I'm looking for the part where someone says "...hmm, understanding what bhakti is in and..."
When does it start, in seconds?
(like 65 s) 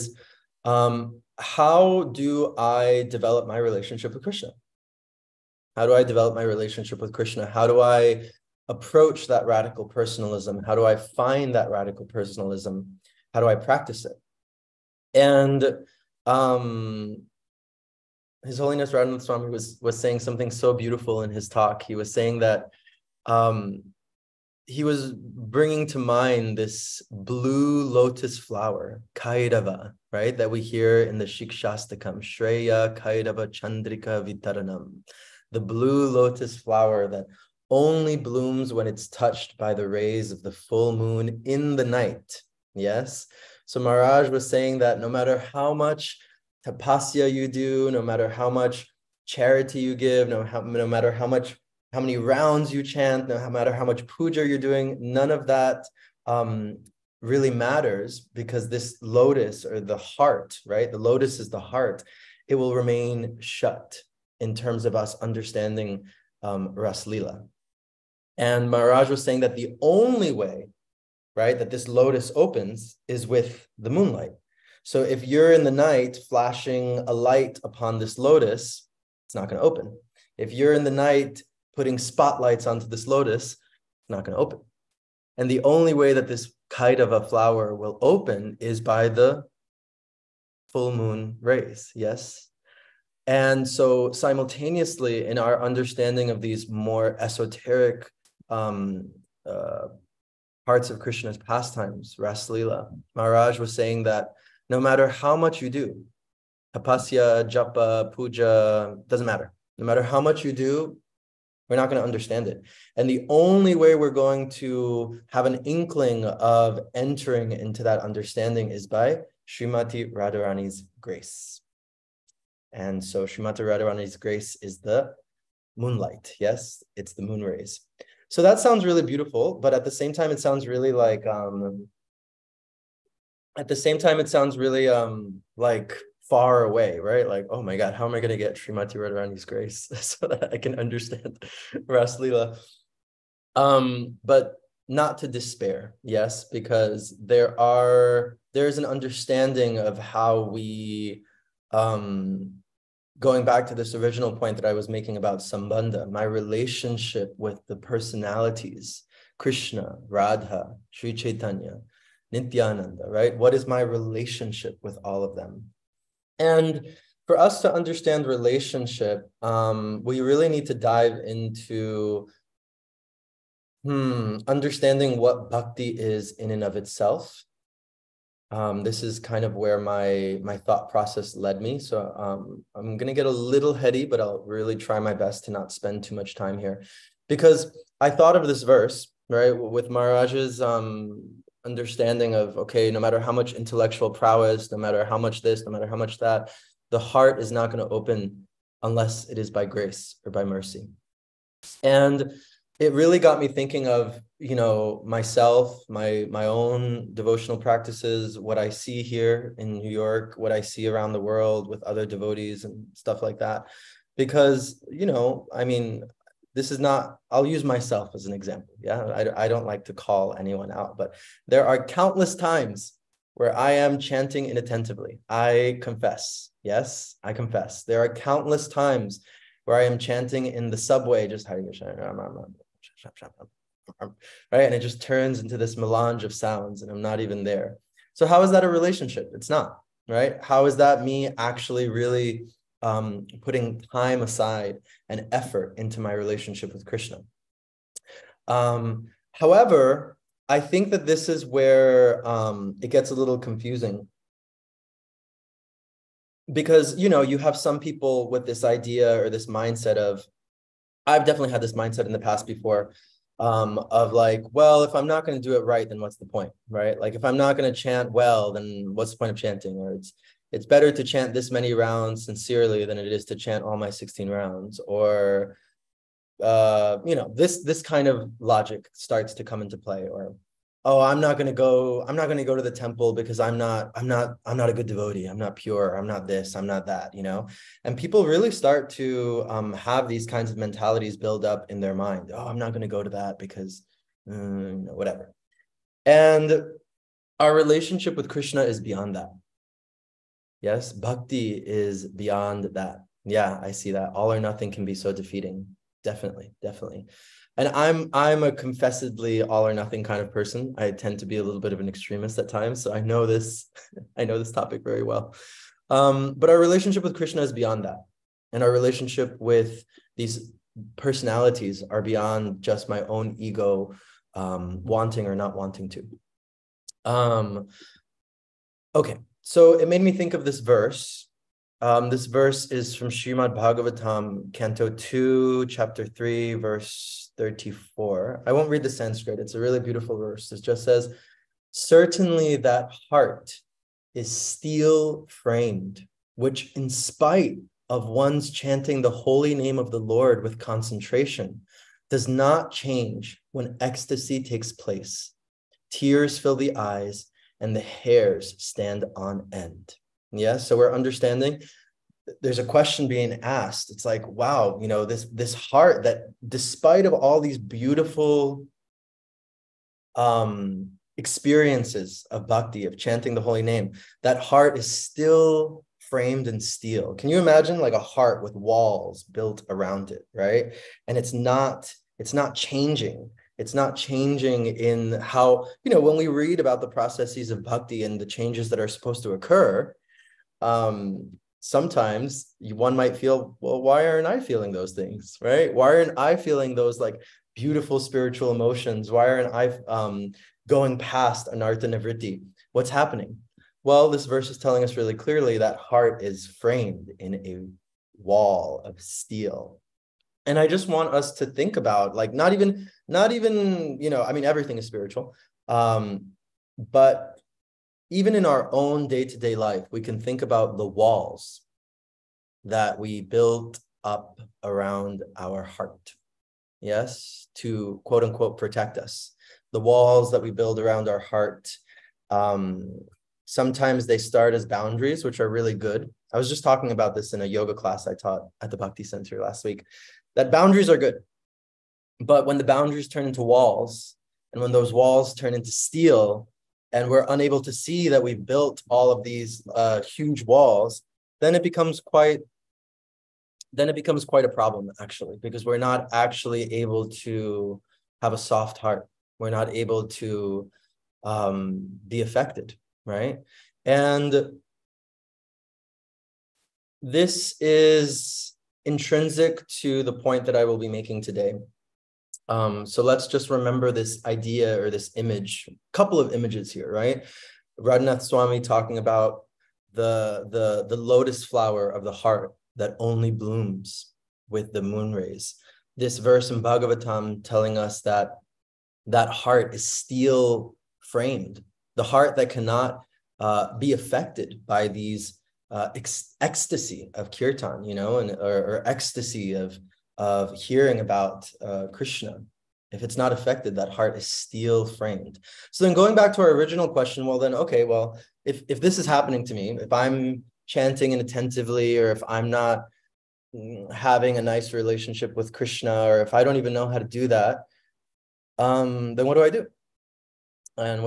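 173 s.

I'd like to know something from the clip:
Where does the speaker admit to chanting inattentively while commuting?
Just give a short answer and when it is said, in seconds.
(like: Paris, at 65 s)
the subway, at 230 s.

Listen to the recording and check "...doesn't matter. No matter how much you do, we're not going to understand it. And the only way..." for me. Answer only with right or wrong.
right.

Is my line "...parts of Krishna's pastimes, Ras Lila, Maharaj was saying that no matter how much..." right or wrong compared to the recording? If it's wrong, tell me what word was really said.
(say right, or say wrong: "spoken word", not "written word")
right.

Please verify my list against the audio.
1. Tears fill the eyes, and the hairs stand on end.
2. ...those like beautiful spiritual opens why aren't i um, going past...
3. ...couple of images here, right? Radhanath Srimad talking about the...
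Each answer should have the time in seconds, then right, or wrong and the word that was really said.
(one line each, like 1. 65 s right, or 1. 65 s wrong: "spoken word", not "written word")
1. 355 s right
2. 396 s wrong: "emotions", not "opens"
3. 475 s wrong: "Swami", not "Srimad".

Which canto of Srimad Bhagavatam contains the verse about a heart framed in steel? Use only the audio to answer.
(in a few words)
Canto 2.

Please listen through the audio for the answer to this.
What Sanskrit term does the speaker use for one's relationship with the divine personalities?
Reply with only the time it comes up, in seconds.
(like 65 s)
155 s.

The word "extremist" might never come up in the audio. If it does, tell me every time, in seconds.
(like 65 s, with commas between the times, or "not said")
311 s.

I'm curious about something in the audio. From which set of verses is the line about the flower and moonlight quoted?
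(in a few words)
Shikshastakam.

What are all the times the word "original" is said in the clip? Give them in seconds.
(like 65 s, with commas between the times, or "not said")
153 s, 506 s.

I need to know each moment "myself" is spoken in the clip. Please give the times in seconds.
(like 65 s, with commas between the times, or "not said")
205 s, 217 s.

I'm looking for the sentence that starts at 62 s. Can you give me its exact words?
It will remain shut in terms of us understanding um, Raslila.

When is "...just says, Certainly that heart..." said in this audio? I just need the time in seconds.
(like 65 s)
340 s.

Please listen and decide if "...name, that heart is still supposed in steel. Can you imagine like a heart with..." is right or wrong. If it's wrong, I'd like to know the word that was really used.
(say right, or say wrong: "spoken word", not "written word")
wrong: "framed", not "supposed".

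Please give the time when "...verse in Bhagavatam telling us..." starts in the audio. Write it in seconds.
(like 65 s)
486 s.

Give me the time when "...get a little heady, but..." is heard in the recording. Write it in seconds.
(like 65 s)
183 s.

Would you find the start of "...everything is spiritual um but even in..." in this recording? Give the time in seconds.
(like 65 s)
414 s.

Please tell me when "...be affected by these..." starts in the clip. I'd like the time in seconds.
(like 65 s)
493 s.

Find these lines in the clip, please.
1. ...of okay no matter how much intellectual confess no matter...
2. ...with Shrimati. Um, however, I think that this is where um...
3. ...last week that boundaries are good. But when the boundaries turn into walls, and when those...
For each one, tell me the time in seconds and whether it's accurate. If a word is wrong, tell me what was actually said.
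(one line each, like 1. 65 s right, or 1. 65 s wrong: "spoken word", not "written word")
1. 192 s wrong: "prowess", not "confess"
2. 246 s wrong: "Krishna", not "Shrimati"
3. 439 s right.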